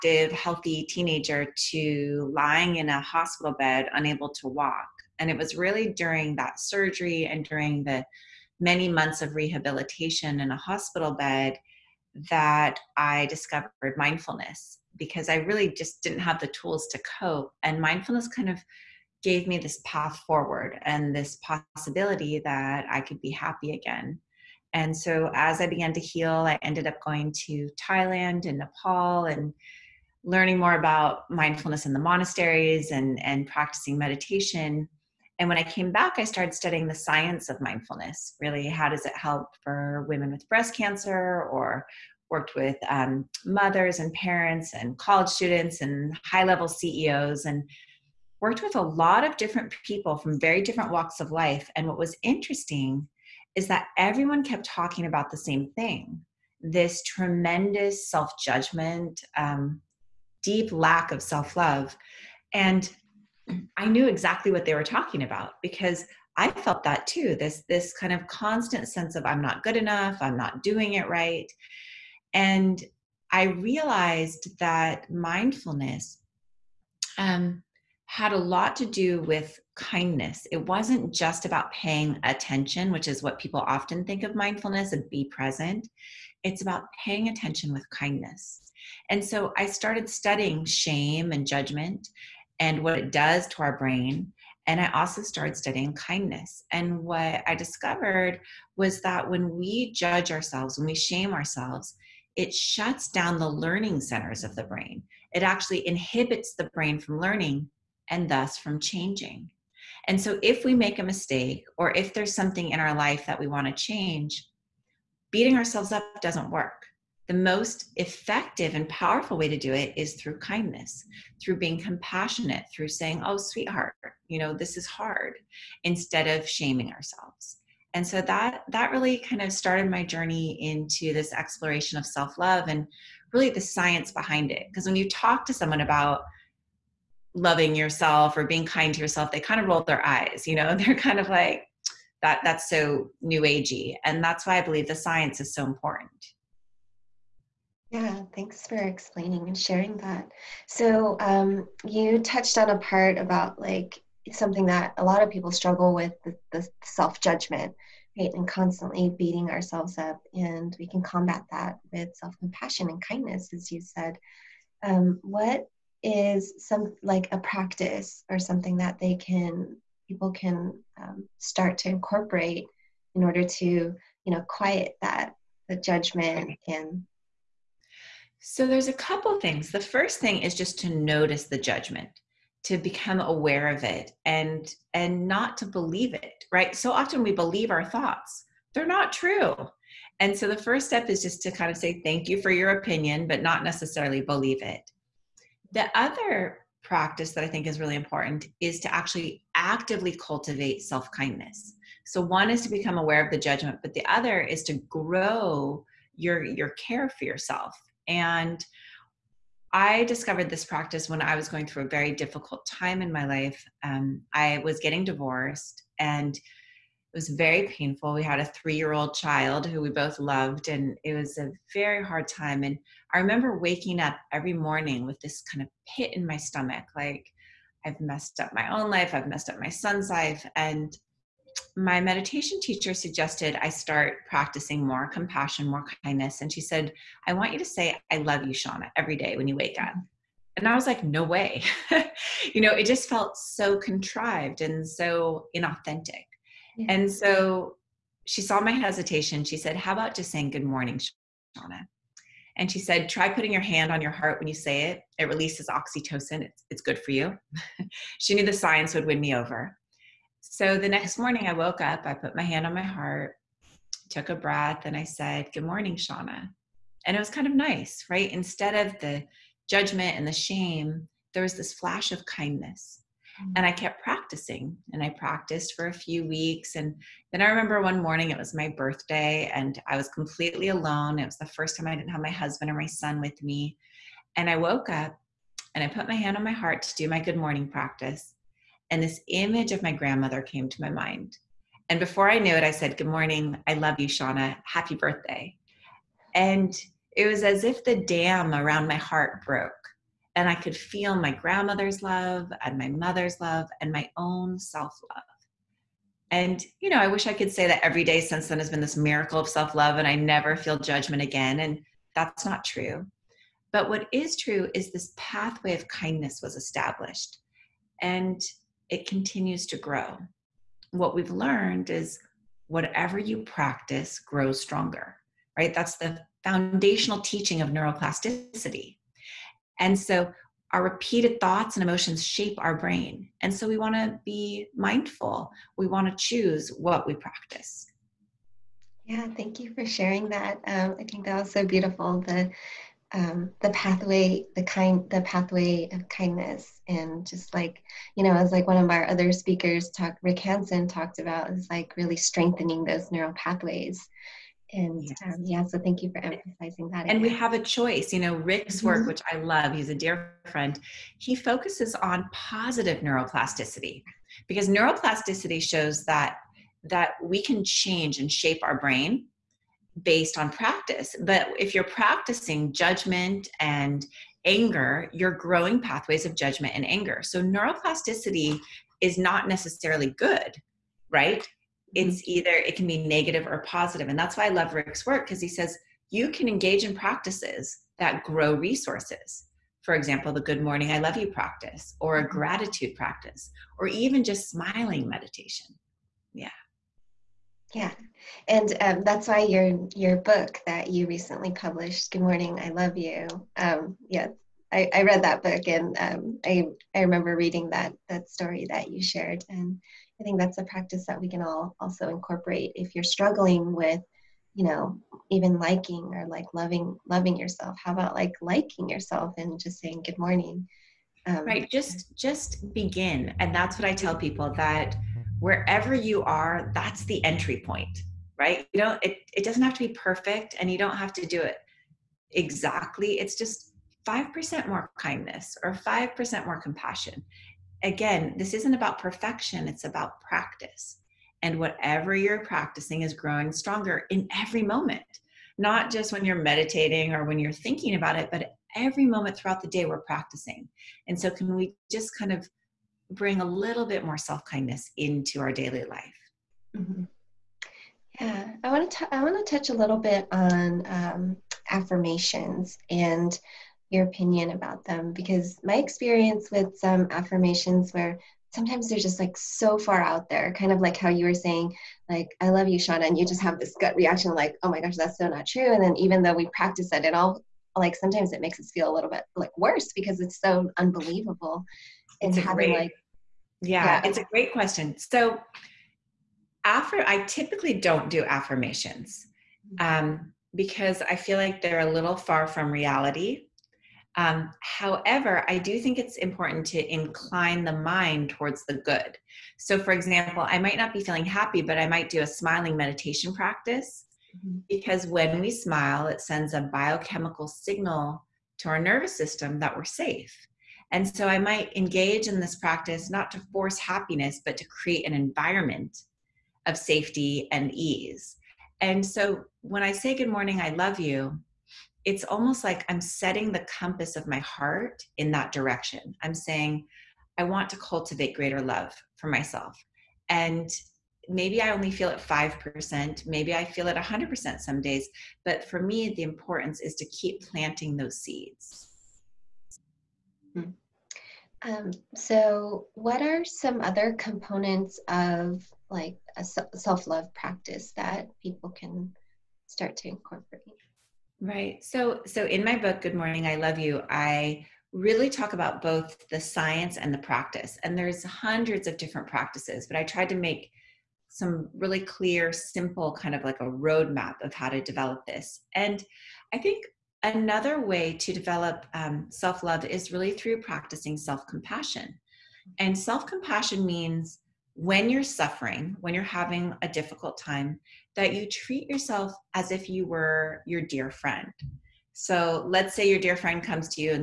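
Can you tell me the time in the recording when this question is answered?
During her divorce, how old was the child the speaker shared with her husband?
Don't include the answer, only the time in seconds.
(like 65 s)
218 s.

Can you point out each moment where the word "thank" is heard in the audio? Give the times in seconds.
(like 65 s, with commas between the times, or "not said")
148 s, 192 s, 339 s, 355 s.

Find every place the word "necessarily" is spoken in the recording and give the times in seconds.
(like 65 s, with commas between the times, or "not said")
193 s, 379 s.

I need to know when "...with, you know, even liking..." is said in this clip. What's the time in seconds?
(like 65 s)
413 s.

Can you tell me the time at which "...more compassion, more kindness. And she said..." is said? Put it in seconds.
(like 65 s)
234 s.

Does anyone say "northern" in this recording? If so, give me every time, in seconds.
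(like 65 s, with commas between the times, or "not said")
not said.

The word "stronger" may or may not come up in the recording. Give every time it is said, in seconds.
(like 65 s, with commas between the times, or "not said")
324 s, 443 s.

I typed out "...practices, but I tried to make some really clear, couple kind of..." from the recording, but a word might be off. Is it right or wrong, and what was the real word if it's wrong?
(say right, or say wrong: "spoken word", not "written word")
wrong: "simple", not "couple".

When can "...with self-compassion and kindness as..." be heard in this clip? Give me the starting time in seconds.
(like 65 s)
161 s.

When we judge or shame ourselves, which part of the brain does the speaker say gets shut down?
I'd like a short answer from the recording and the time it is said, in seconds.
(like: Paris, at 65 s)
learning centers, at 103 s.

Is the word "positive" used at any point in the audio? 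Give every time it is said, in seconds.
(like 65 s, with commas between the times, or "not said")
362 s, 383 s.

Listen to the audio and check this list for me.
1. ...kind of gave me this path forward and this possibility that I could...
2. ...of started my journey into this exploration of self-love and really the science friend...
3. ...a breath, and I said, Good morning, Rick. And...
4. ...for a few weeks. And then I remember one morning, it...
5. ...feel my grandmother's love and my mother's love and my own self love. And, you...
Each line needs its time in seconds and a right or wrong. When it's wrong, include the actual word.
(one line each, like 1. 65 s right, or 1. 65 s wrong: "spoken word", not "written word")
1. 18 s right
2. 129 s wrong: "behind", not "friend"
3. 264 s wrong: "Shauna", not "Rick"
4. 275 s right
5. 300 s right.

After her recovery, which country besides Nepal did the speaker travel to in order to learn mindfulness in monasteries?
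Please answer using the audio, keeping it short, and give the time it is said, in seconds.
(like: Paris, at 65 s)
Thailand, at 27 s.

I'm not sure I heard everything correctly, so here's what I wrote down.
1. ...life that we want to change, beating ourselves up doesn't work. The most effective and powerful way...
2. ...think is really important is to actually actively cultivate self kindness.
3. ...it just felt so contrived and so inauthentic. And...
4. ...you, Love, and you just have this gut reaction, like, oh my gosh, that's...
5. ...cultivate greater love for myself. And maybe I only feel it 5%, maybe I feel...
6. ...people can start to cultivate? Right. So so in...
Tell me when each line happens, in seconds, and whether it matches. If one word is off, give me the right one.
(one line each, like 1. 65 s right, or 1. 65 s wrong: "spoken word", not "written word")
1. 112 s right
2. 197 s right
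3. 242 s right
4. 472 s wrong: "Shauna", not "Love"
5. 527 s right
6. 548 s wrong: "incorporate", not "cultivate".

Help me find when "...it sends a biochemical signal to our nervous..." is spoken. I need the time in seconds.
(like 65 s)
506 s.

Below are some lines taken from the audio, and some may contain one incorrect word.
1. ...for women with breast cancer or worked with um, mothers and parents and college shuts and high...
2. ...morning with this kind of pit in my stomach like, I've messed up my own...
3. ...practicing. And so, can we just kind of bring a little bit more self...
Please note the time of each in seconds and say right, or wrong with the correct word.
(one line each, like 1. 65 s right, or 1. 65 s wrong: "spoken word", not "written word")
1. 39 s wrong: "students", not "shuts"
2. 224 s right
3. 450 s right.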